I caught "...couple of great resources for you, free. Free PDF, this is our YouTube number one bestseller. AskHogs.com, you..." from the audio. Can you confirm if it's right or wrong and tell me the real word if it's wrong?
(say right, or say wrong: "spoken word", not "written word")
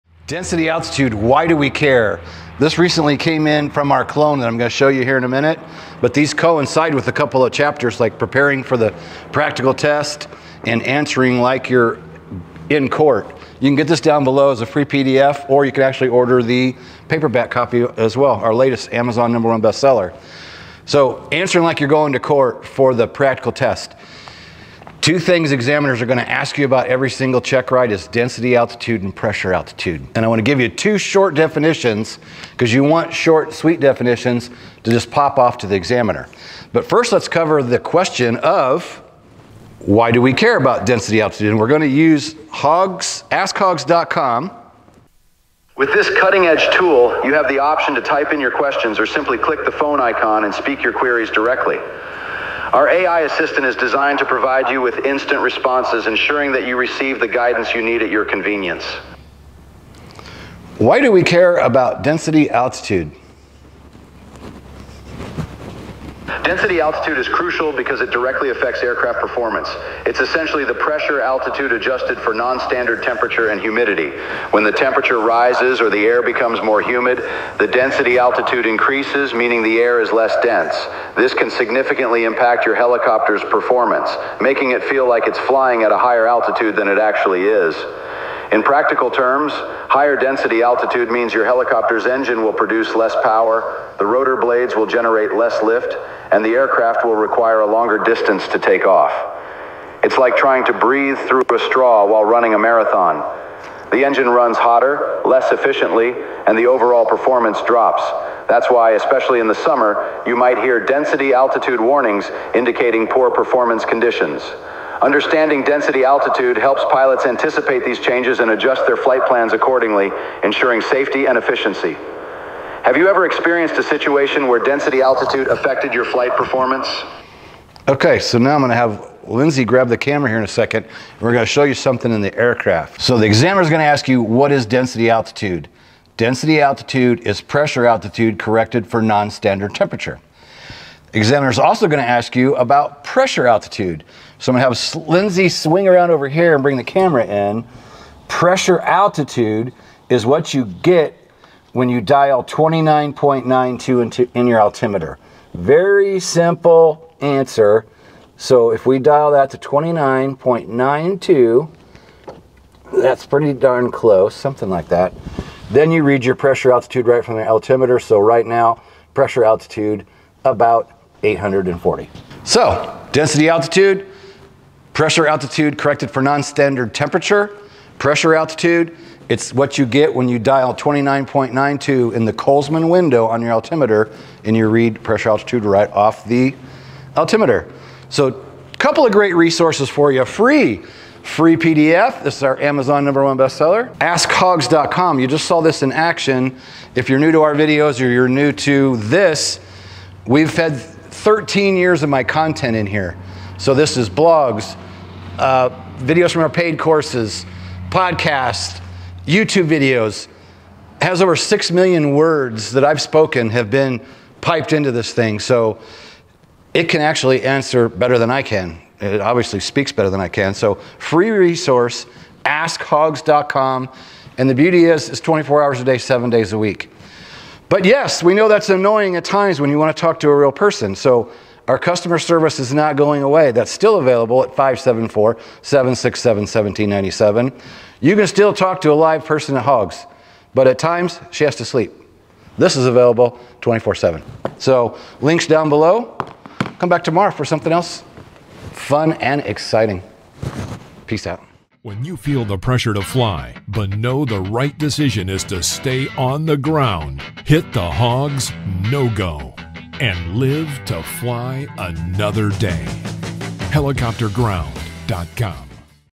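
wrong: "Amazon", not "YouTube".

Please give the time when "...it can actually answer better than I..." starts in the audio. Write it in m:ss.
3:36.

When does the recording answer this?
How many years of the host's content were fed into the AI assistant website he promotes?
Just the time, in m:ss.
3:21.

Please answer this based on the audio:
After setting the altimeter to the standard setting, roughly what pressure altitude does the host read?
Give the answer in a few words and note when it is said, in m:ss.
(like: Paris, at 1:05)
About 840, at 2:50.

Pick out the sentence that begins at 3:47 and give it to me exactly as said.
But yes, we know that's annoying at times when you want to talk to a real person.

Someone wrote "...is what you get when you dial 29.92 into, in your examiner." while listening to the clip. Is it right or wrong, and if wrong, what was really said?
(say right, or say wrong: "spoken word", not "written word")
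wrong: "altimeter", not "examiner".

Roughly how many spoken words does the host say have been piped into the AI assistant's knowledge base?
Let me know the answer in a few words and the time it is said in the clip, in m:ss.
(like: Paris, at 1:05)
Over 6 million, at 3:31.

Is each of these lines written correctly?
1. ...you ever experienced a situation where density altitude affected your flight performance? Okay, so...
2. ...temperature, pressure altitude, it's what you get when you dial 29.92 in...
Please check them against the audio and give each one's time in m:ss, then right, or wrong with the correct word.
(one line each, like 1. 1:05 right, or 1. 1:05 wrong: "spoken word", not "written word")
1. 2:02 right
2. 2:56 right.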